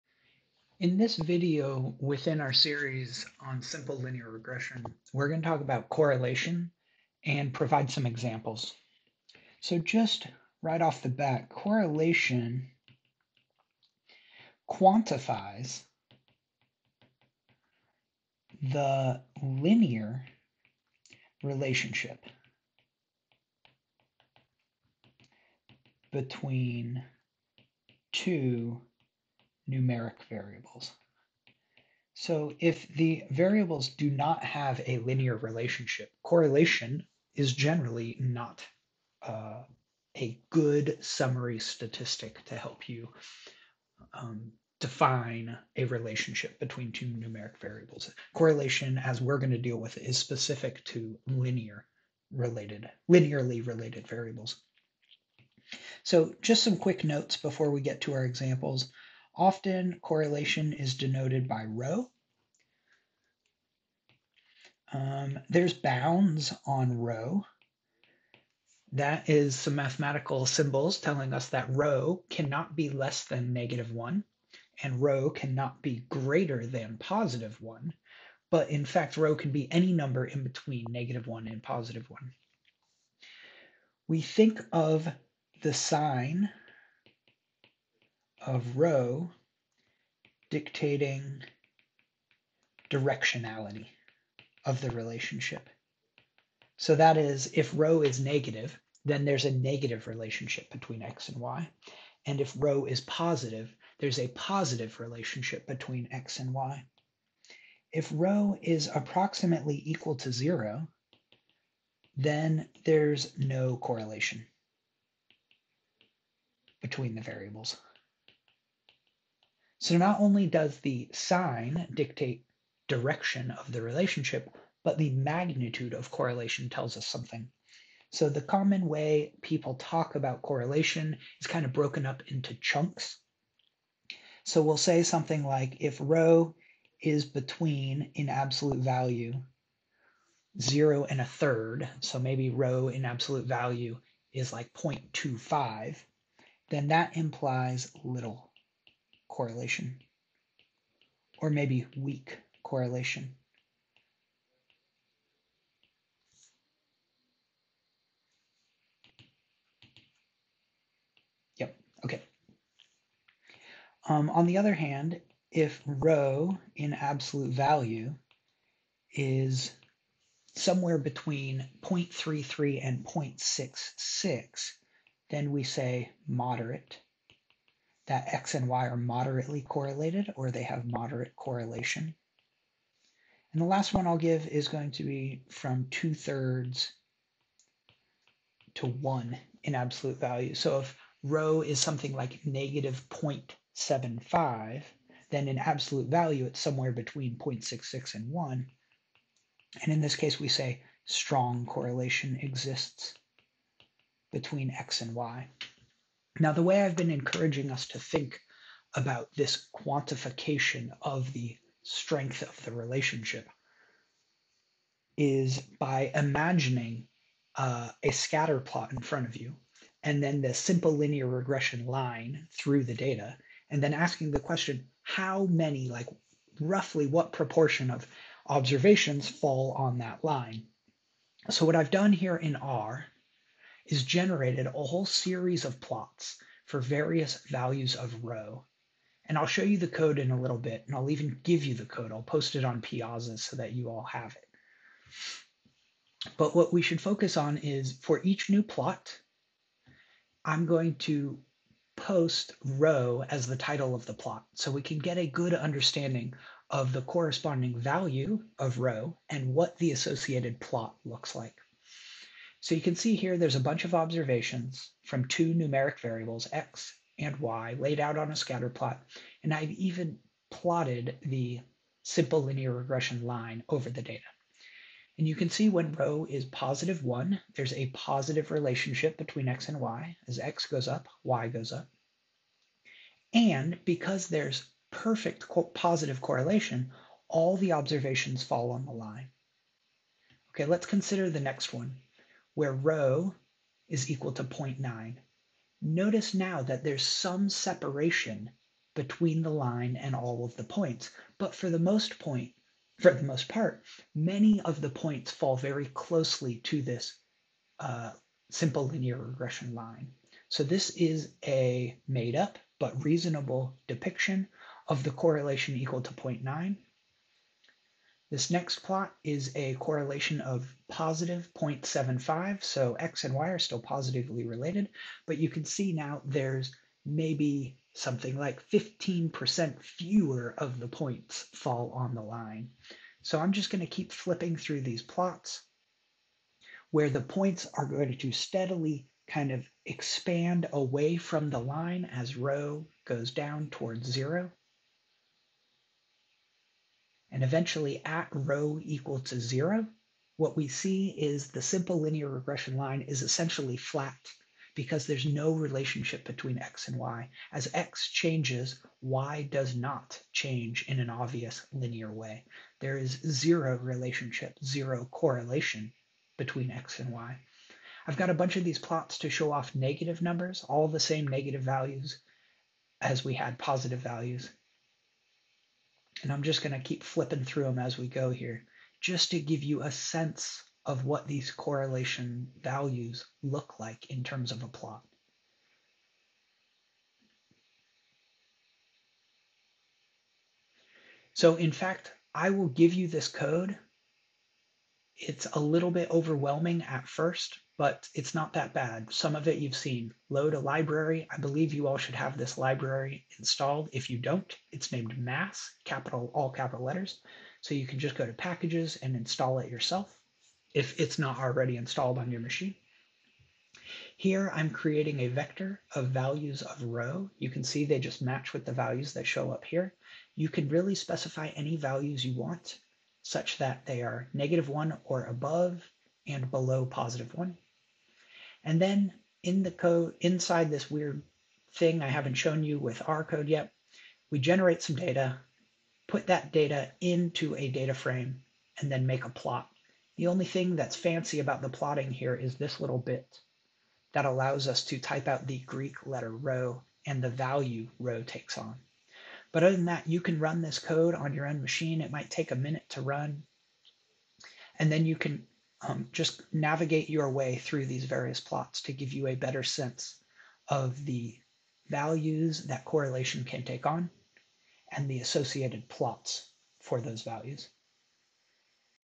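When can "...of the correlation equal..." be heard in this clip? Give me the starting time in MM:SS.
05:14.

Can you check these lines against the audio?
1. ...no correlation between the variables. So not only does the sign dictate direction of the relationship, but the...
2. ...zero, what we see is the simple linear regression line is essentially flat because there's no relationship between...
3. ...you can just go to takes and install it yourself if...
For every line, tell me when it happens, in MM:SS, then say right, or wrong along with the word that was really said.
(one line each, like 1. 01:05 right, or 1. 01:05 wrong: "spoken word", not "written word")
1. 01:53 right
2. 05:49 right
3. 06:47 wrong: "packages", not "takes".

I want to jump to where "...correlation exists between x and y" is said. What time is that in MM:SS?
03:21.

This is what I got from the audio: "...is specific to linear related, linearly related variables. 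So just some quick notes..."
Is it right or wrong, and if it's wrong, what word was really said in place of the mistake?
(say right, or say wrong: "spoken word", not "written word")
right.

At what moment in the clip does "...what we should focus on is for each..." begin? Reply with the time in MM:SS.
04:06.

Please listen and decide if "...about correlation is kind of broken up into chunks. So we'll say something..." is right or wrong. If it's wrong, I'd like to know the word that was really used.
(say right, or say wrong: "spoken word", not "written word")
right.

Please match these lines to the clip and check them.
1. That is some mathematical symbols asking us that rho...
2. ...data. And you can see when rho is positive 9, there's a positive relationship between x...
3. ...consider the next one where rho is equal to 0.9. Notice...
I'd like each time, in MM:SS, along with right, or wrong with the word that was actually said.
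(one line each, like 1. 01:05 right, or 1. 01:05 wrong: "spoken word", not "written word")
1. 01:08 wrong: "telling", not "asking"
2. 04:34 wrong: "1", not "9"
3. 04:50 right.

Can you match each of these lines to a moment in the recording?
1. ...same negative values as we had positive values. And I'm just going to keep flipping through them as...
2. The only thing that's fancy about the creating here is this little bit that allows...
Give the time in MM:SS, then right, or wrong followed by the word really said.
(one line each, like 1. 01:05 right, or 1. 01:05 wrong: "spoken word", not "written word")
1. 06:10 right
2. 07:20 wrong: "plotting", not "creating".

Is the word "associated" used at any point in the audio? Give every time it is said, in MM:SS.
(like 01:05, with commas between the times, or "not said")
04:19, 07:45.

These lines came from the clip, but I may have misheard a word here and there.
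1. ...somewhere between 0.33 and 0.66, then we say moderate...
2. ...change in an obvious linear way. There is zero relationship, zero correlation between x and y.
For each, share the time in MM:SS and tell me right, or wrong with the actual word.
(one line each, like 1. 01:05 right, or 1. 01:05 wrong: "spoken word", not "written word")
1. 02:50 right
2. 06:00 right.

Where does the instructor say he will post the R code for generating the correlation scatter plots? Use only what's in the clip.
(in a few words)
Piazza.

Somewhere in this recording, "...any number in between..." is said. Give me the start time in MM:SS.
01:19.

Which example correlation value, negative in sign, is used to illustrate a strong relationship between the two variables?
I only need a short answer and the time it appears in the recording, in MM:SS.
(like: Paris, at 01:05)
-0.75, at 03:12.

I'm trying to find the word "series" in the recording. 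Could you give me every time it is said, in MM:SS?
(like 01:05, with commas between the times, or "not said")
00:02, 03:55.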